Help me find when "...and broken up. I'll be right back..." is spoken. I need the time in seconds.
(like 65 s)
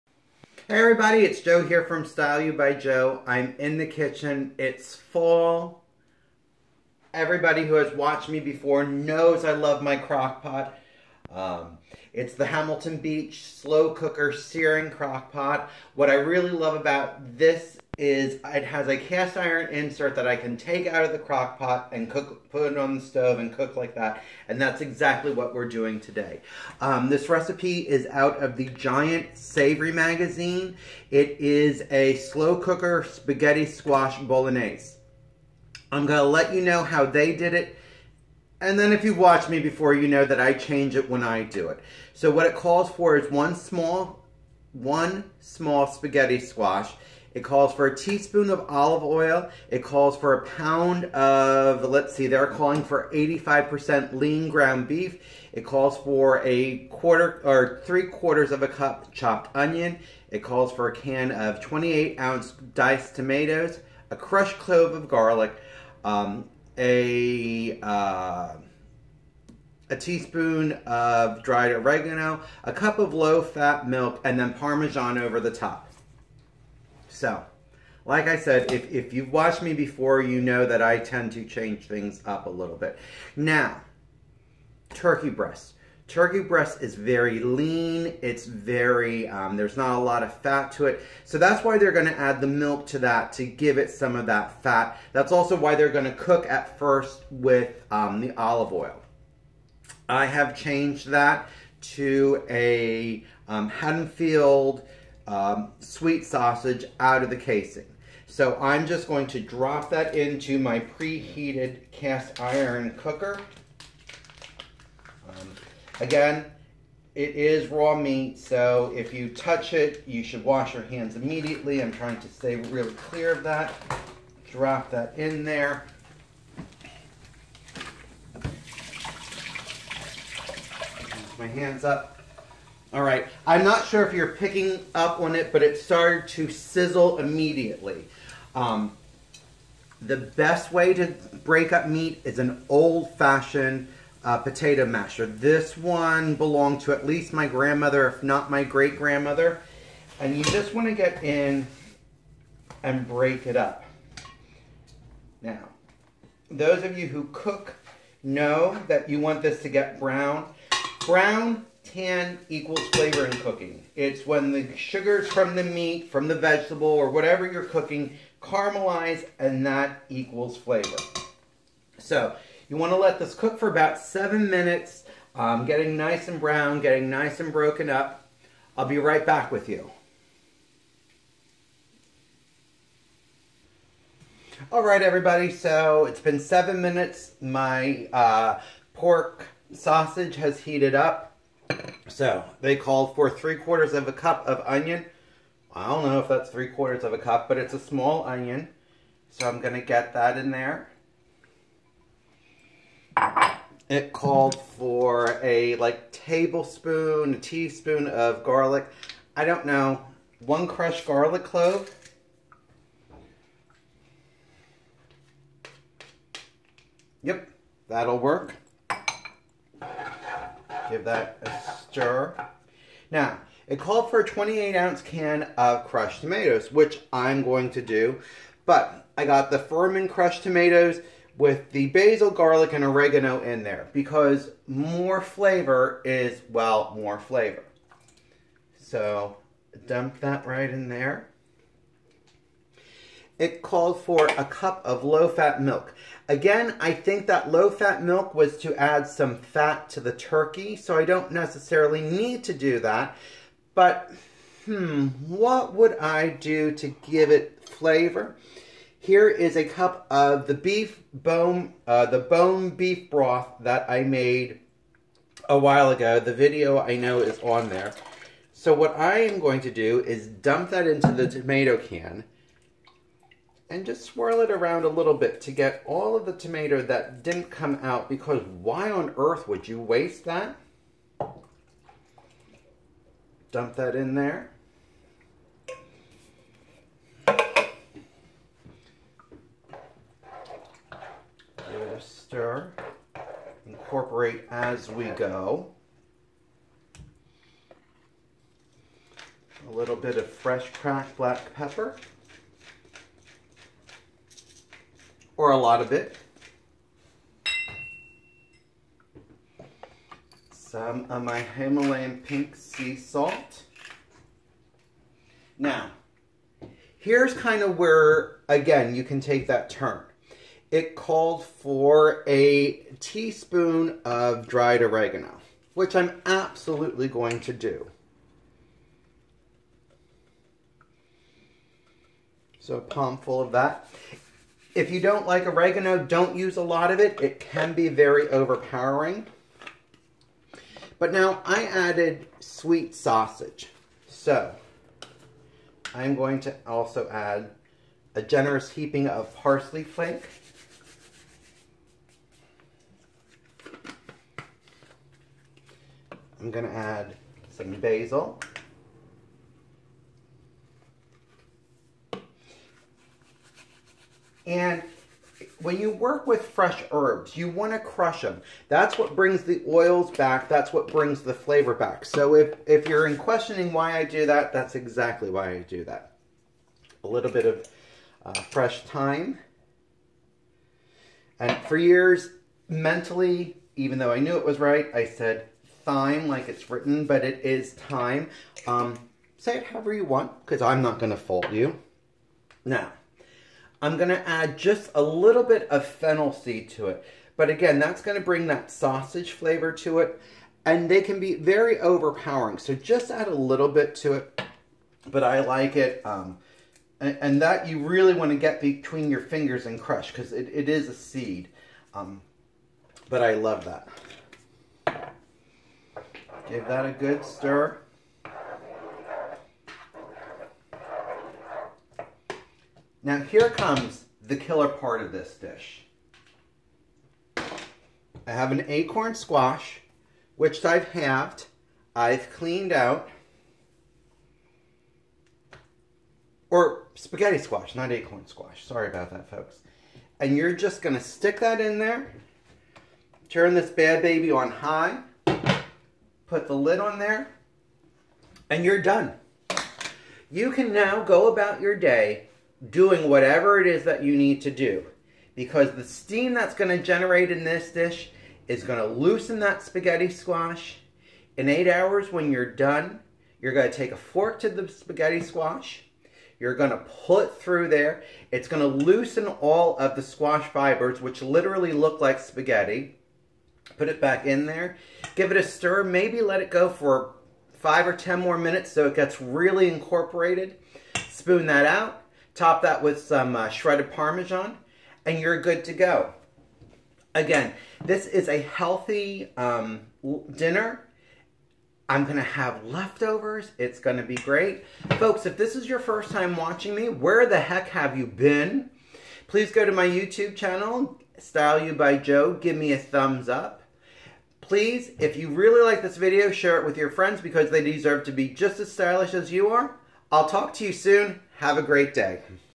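177 s.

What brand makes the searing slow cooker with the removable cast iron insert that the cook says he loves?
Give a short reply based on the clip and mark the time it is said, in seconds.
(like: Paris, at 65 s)
Hamilton Beach, at 12 s.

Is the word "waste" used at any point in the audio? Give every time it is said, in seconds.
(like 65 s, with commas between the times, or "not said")
279 s.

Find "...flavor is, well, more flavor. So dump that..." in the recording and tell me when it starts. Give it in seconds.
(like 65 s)
235 s.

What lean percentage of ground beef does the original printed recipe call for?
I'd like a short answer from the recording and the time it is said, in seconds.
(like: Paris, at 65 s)
85%, at 53 s.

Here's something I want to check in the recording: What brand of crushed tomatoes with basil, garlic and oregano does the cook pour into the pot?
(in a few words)
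Furmano's.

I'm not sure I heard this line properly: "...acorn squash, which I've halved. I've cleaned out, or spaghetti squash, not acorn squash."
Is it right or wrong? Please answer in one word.
right.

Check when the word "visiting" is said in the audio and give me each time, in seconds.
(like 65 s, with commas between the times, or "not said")
not said.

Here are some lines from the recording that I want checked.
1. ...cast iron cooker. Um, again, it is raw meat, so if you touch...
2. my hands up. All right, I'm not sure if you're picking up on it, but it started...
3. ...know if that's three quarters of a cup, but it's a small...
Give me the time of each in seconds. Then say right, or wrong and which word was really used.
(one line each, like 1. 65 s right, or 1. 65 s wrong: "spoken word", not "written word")
1. 111 s right
2. 131 s right
3. 196 s right.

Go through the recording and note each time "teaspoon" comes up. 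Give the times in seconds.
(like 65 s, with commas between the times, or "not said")
47 s, 69 s, 207 s, 323 s.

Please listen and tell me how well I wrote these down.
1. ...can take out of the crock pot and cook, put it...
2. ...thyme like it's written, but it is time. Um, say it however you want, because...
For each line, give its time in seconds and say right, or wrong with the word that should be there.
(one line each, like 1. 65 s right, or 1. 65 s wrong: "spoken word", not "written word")
1. 20 s right
2. 385 s right.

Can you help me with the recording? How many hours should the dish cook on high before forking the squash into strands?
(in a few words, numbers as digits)
8.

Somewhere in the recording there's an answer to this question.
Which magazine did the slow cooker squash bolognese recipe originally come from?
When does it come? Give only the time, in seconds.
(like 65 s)
28 s.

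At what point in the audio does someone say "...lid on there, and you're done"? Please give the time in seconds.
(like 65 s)
446 s.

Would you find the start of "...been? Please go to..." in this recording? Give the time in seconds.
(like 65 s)
498 s.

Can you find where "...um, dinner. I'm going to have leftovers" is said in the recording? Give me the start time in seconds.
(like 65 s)
489 s.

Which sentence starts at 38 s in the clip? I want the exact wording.
And then if you watch me before, you know that I change it when I do it.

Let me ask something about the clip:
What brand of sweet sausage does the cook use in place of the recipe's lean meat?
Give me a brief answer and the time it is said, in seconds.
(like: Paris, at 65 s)
Hatfield, at 103 s.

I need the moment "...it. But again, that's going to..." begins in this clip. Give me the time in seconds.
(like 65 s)
396 s.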